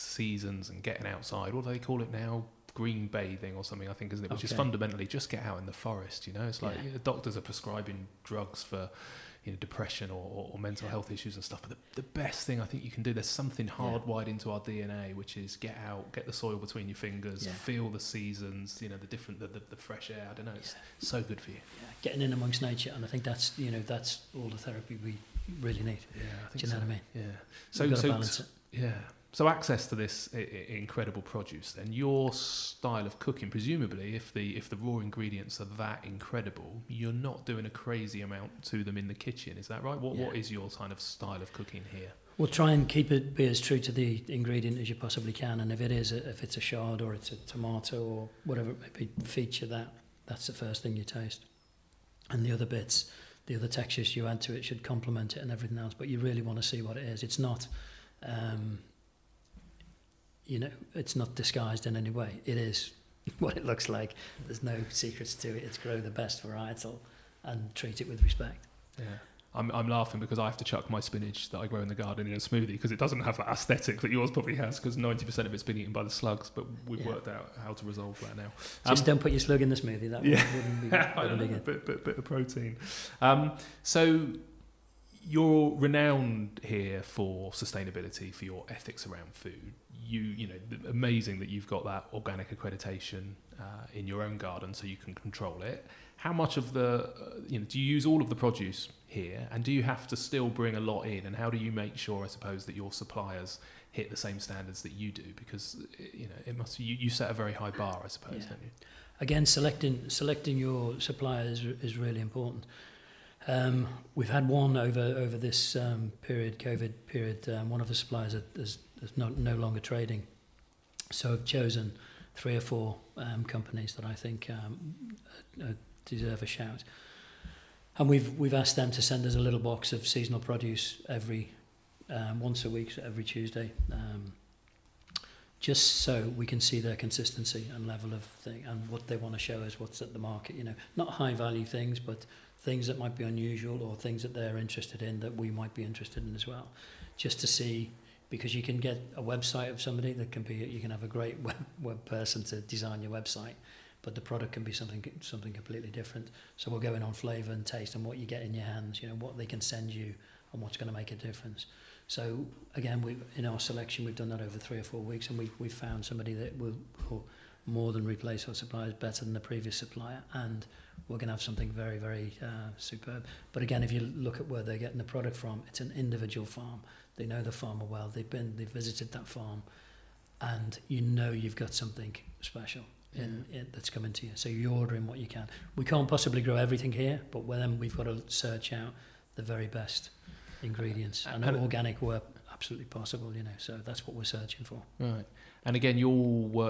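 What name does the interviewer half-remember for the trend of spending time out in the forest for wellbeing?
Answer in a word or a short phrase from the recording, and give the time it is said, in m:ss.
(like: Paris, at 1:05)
Green bathing, at 0:02.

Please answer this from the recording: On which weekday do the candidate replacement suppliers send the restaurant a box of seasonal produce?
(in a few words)
Tuesday.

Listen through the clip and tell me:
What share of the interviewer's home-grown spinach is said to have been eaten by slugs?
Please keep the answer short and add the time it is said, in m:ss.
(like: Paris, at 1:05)
90%, at 1:14.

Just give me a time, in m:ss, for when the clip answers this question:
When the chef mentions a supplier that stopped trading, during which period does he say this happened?
1:56.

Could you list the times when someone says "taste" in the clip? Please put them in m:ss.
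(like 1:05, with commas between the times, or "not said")
0:51, 2:37.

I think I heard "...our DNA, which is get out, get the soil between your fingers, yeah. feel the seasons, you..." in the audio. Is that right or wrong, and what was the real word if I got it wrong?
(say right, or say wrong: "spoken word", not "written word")
right.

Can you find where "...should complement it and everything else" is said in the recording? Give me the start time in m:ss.
0:54.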